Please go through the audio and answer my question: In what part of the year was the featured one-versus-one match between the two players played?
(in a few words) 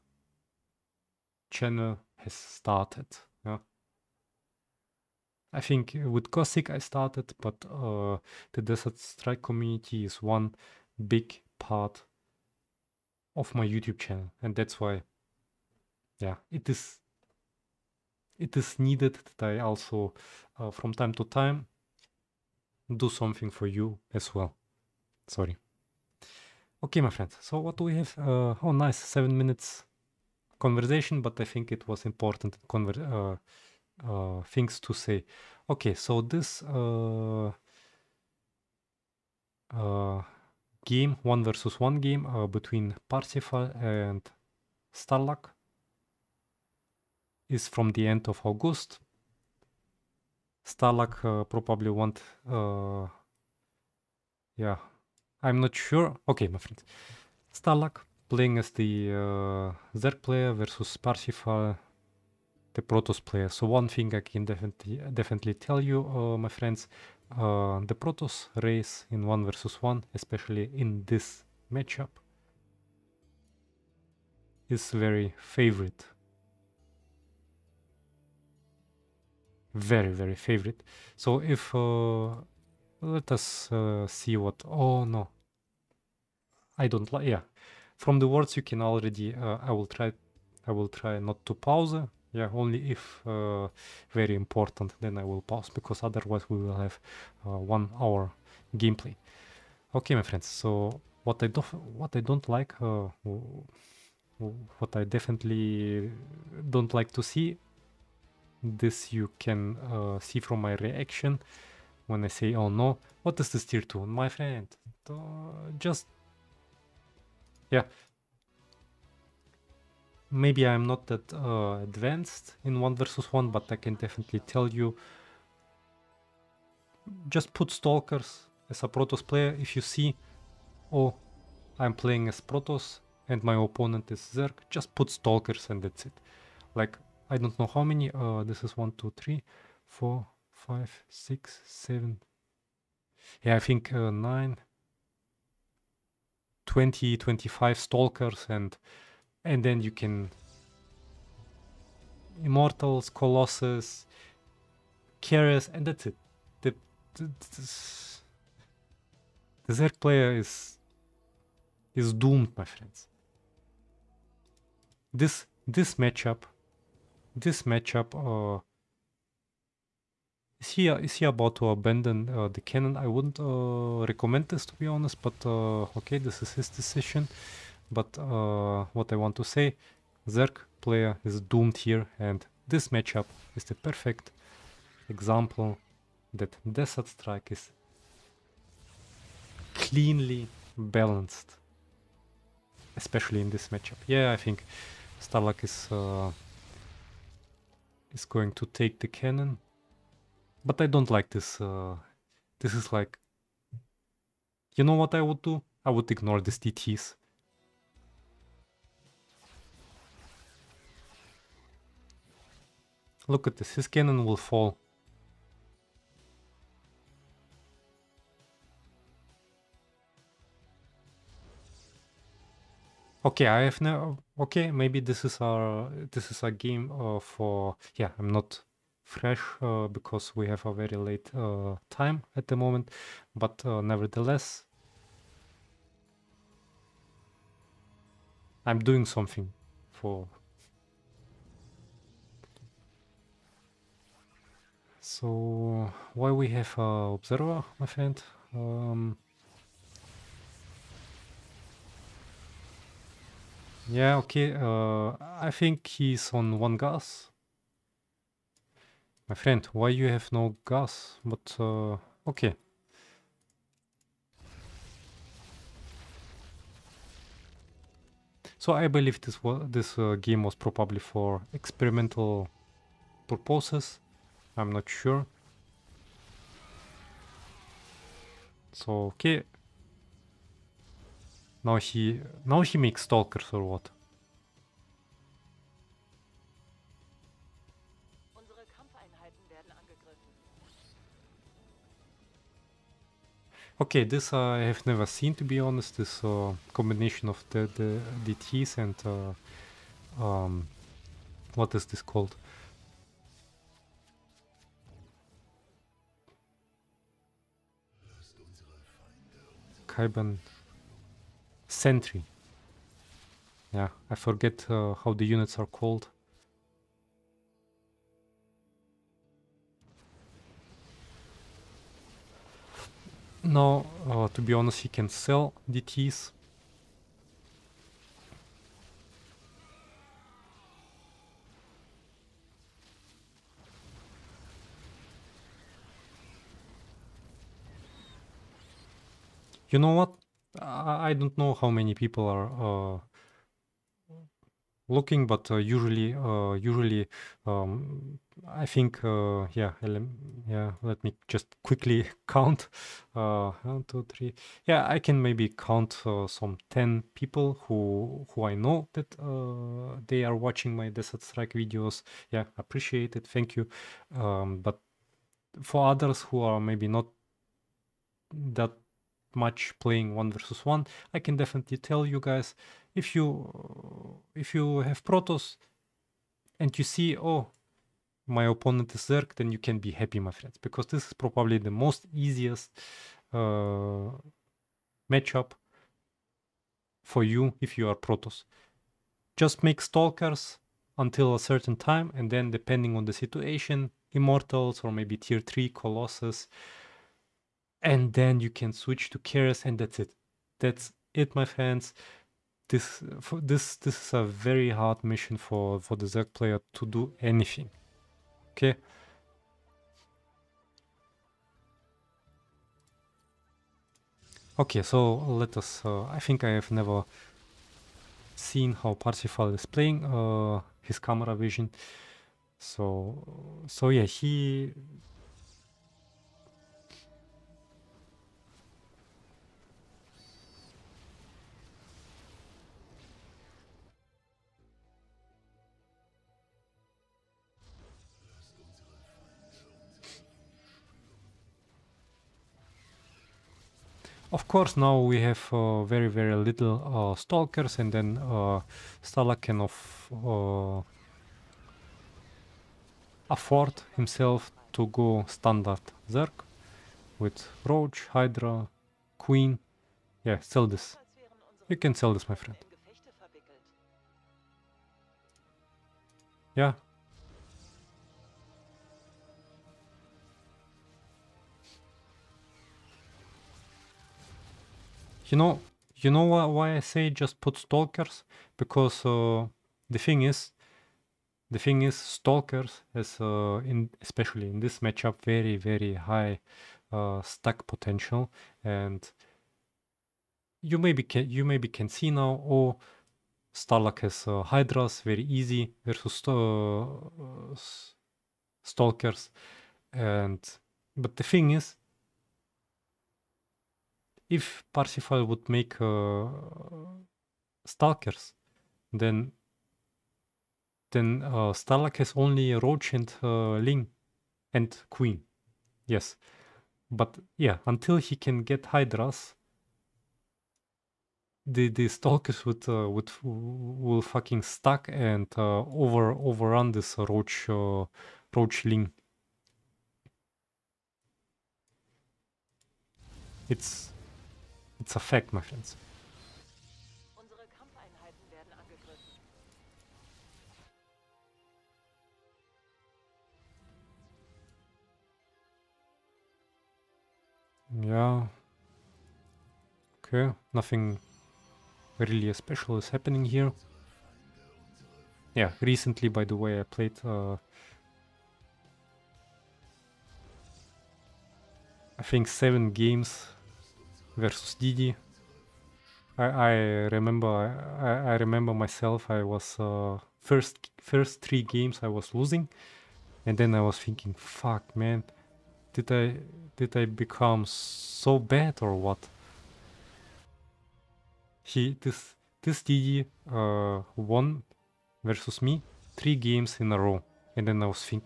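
End of August.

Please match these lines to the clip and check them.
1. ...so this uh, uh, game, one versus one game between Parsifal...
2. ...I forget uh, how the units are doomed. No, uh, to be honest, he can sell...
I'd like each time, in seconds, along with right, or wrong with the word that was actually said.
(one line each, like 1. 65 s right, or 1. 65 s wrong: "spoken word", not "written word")
1. 35 s right
2. 314 s wrong: "called", not "doomed".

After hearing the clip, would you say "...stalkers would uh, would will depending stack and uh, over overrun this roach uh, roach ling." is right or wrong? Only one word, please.
wrong.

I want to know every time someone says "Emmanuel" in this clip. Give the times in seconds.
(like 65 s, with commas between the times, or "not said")
not said.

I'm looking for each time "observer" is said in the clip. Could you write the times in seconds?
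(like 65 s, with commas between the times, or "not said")
247 s.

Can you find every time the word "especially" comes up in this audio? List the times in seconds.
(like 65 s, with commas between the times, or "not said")
70 s, 192 s, 483 s.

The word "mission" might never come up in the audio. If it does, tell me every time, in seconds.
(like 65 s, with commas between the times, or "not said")
405 s.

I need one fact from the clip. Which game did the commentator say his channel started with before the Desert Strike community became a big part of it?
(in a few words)
Cossack.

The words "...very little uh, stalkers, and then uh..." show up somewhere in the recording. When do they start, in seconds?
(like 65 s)
446 s.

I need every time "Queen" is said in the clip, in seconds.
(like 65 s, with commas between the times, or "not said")
459 s, 514 s.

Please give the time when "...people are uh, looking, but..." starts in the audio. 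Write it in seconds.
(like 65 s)
341 s.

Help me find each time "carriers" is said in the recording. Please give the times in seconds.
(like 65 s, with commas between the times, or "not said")
155 s, 399 s.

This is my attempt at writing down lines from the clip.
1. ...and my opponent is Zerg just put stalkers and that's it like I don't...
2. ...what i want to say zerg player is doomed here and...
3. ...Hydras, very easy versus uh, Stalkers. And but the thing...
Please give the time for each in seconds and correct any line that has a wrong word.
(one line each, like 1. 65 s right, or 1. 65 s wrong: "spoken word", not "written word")
1. 133 s right
2. 178 s right
3. 494 s right.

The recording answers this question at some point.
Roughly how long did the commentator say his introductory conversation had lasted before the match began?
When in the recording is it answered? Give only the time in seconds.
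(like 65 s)
28 s.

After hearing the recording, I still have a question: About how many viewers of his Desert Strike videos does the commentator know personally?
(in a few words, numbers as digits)
10.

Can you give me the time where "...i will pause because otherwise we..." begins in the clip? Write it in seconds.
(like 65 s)
95 s.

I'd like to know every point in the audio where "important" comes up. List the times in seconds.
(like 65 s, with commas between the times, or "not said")
32 s, 94 s.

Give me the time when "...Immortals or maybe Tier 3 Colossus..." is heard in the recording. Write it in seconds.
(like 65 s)
394 s.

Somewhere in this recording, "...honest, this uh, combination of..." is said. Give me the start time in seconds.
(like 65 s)
295 s.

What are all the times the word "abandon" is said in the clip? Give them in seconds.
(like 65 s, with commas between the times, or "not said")
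171 s.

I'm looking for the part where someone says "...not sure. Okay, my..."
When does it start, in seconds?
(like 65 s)
55 s.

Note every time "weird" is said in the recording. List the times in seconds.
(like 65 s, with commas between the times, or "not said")
not said.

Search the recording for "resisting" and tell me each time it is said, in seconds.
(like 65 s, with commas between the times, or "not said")
not said.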